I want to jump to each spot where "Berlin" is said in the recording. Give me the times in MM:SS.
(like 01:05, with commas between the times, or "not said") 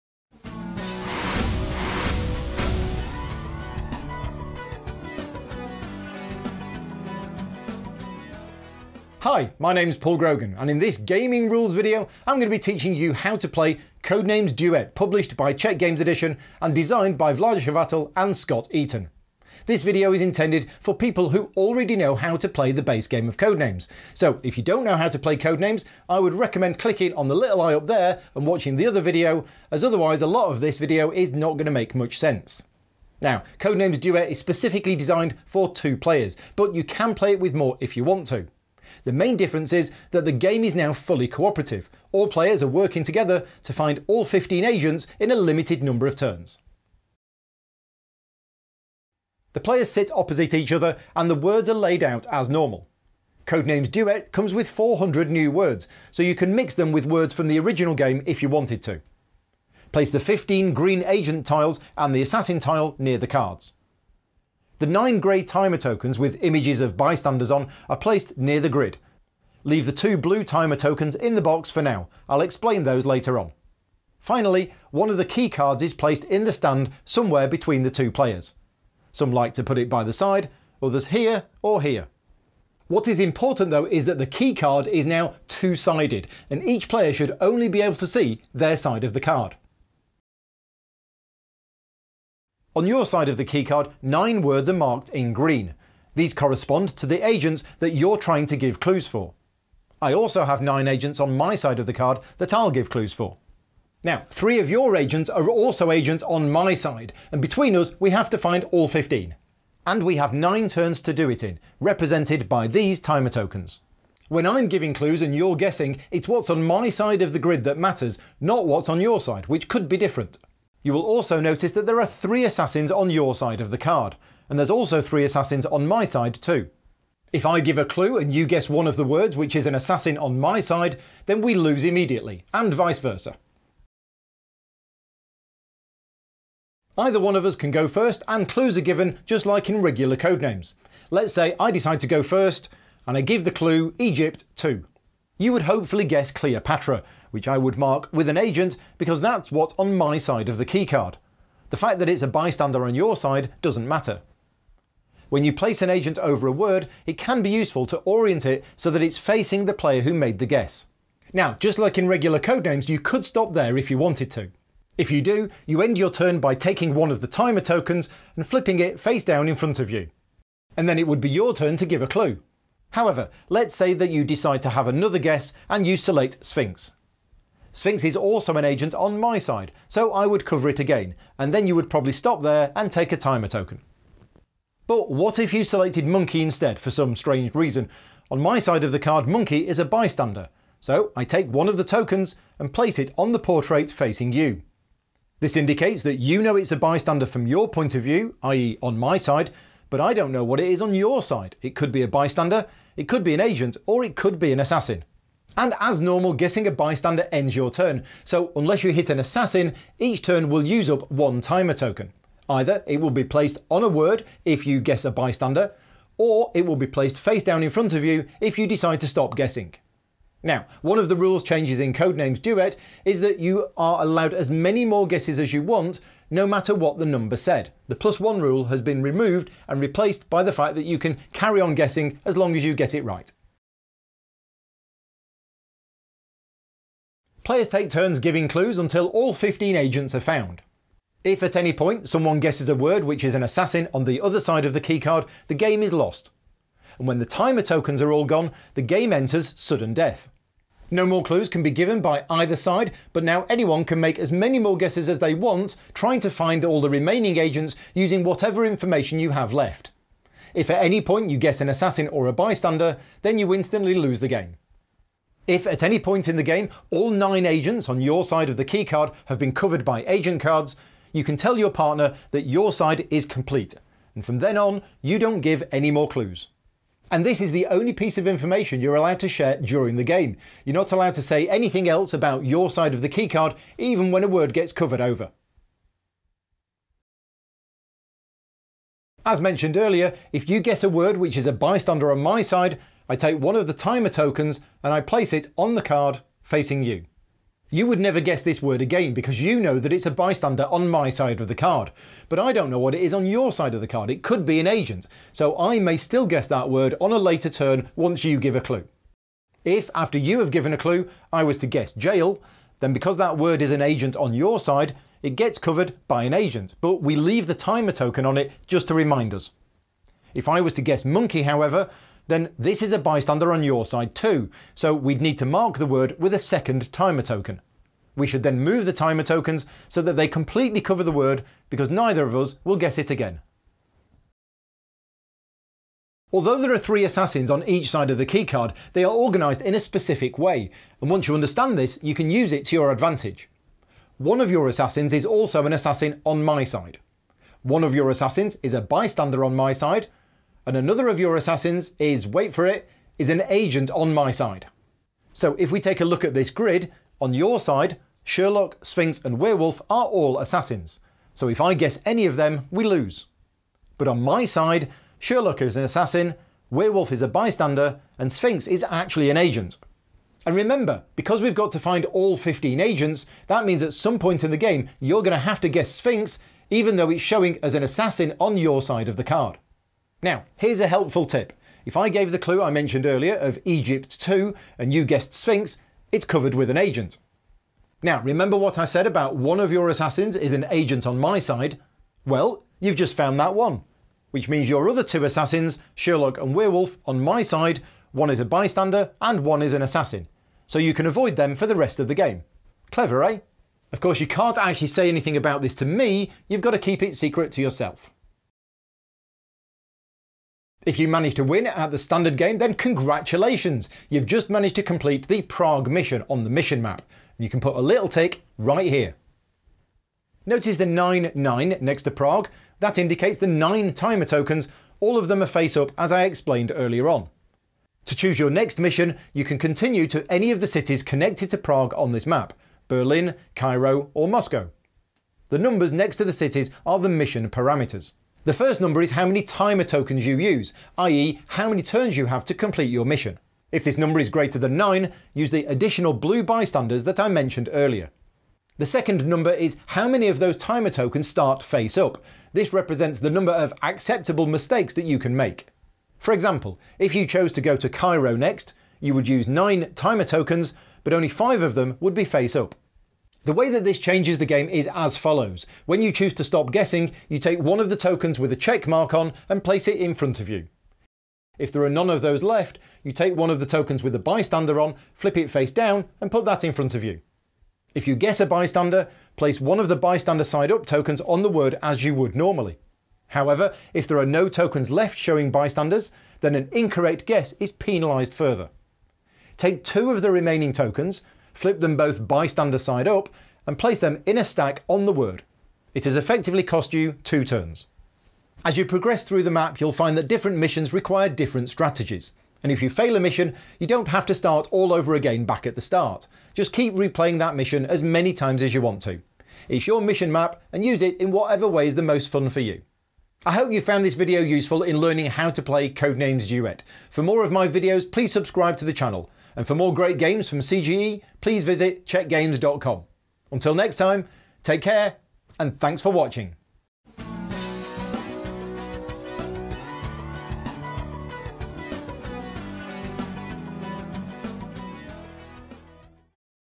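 07:12.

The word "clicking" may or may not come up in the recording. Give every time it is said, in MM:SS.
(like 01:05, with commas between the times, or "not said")
00:26.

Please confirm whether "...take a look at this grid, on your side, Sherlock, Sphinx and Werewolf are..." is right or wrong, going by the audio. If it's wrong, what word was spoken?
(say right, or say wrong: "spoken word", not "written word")
right.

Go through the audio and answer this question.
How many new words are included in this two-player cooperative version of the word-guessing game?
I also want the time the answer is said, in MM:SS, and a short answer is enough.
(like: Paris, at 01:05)
400, at 00:54.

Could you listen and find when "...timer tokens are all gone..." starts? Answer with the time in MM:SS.
04:07.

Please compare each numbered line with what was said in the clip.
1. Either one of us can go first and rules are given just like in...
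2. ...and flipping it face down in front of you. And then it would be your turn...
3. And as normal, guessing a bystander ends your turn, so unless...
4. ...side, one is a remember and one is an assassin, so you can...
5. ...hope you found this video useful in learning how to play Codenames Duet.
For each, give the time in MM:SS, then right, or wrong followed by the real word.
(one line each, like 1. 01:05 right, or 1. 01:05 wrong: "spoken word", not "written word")
1. 02:16 wrong: "clues", not "rules"
2. 02:48 right
3. 03:25 right
4. 06:37 wrong: "bystander", not "remember"
5. 08:33 right.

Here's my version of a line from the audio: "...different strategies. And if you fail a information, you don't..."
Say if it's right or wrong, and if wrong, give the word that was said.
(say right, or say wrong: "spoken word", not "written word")
wrong: "mission", not "information".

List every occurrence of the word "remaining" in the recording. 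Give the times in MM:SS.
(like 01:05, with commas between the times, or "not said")
04:16, 08:10.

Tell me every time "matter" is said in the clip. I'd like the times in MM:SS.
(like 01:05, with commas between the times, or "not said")
01:57, 02:33, 03:46.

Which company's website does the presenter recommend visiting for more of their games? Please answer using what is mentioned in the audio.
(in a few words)
czechgames.com.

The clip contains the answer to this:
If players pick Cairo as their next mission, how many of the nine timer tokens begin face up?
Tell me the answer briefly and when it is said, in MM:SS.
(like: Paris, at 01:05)
5, at 07:41.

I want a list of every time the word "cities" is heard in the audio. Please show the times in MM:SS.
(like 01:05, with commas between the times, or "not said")
07:10, 07:16.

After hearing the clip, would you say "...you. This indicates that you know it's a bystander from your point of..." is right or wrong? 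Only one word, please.
right.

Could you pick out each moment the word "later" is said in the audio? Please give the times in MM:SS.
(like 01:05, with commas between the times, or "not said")
01:13, 05:07.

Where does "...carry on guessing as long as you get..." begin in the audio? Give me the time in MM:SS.
03:51.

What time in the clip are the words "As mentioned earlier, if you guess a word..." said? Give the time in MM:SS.
04:49.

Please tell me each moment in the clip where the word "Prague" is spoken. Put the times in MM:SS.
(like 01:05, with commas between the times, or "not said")
06:55, 07:02, 07:11.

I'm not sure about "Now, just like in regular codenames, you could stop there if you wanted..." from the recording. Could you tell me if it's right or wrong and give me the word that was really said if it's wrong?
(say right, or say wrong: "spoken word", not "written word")
right.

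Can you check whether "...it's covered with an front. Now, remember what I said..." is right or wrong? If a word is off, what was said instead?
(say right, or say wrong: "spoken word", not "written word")
wrong: "agent", not "front".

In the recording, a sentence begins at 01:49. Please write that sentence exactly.
And we have nine turns to do it in, represented by these timer tokens.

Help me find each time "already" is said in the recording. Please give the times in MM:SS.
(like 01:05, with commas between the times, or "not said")
00:21.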